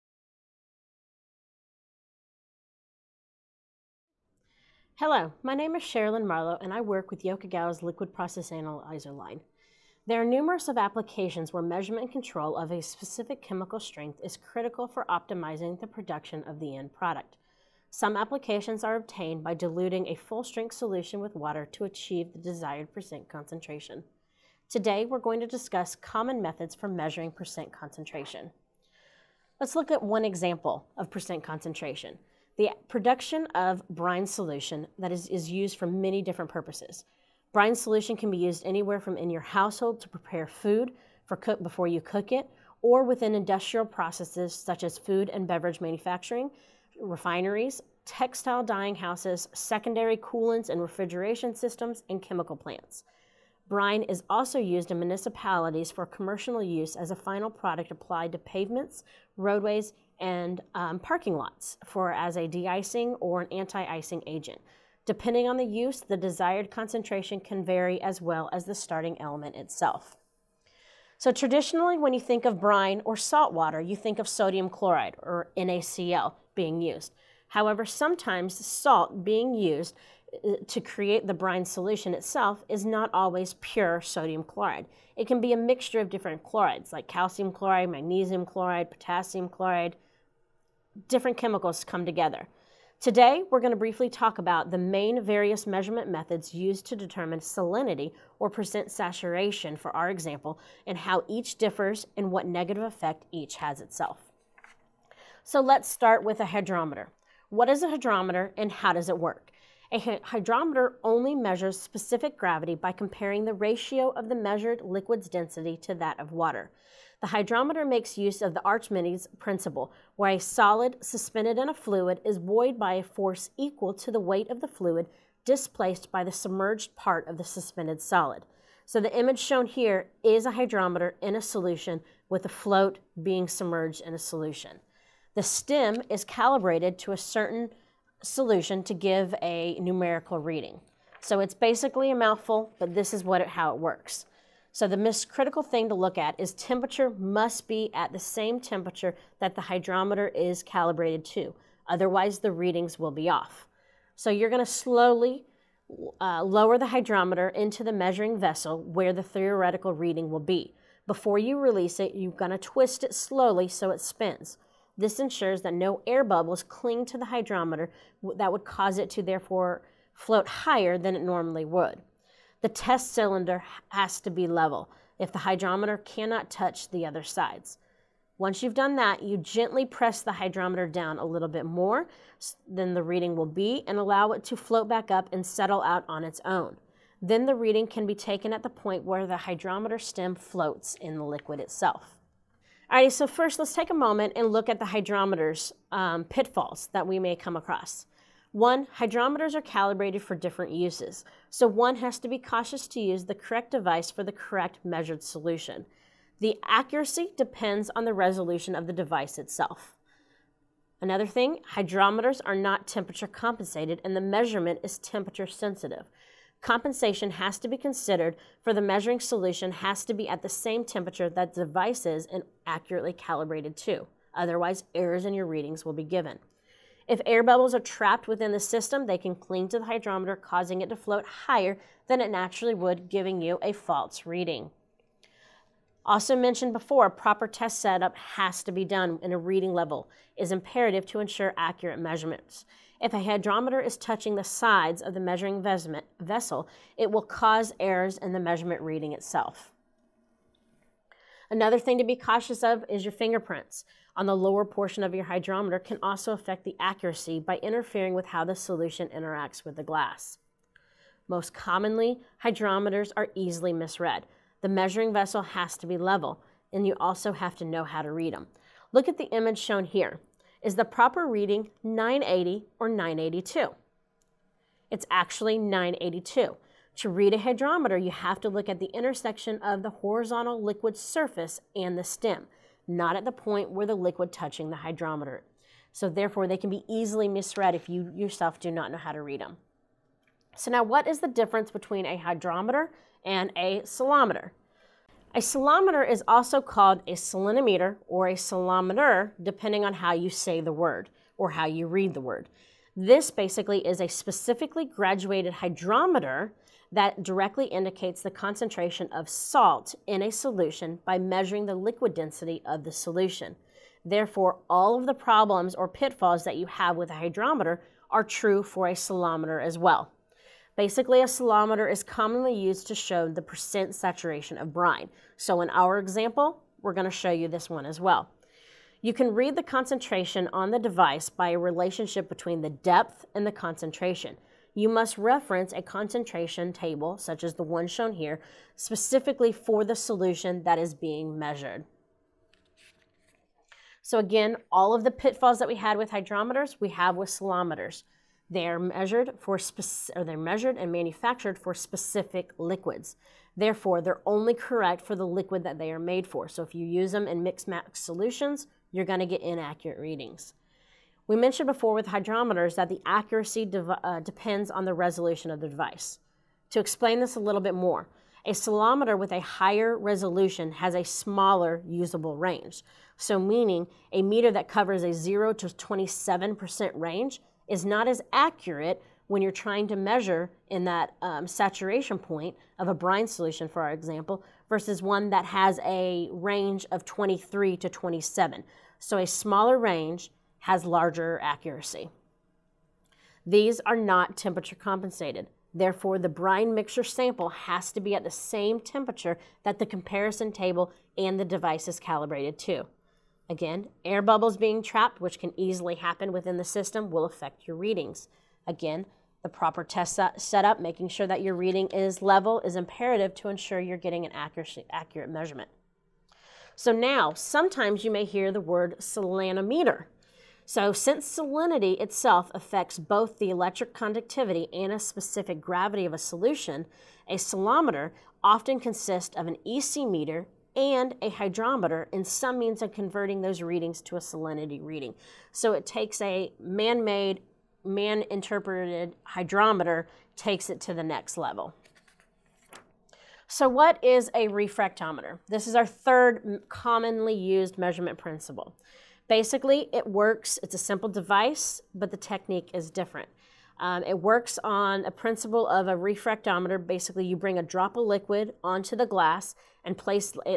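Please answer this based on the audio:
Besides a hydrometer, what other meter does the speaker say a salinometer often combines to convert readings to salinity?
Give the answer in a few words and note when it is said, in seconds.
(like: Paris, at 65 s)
EC meter, at 429 s.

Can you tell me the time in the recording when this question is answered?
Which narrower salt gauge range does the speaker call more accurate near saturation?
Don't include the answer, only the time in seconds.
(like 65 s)
387 s.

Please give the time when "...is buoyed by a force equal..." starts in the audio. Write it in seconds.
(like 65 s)
122 s.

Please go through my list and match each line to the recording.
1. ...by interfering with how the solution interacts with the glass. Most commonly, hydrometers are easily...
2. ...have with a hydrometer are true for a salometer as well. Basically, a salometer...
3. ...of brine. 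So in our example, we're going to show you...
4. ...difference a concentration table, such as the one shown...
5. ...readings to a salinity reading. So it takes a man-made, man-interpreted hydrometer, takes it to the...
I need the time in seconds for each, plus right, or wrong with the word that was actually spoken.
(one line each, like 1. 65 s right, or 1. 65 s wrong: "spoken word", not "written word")
1. 257 s right
2. 316 s right
3. 324 s right
4. 335 s wrong: "reference", not "difference"
5. 433 s right.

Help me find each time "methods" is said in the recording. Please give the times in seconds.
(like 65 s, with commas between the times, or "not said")
26 s, 96 s.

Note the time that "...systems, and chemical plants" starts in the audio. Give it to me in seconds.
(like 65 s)
51 s.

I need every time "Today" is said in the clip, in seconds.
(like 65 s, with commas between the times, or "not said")
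24 s, 93 s.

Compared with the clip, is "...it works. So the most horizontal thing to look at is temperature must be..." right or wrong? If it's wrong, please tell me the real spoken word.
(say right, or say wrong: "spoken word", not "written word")
wrong: "critical", not "horizontal".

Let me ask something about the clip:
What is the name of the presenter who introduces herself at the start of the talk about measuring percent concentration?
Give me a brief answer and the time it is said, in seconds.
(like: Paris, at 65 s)
Sherilyn Marlow, at 5 s.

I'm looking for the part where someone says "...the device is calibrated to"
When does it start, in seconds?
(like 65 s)
401 s.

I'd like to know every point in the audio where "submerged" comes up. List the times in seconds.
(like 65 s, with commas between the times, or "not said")
126 s, 133 s.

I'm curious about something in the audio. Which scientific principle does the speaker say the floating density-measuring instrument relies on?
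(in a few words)
Archimedes principle.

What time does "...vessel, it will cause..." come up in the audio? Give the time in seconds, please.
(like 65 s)
246 s.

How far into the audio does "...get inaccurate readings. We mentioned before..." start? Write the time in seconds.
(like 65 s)
359 s.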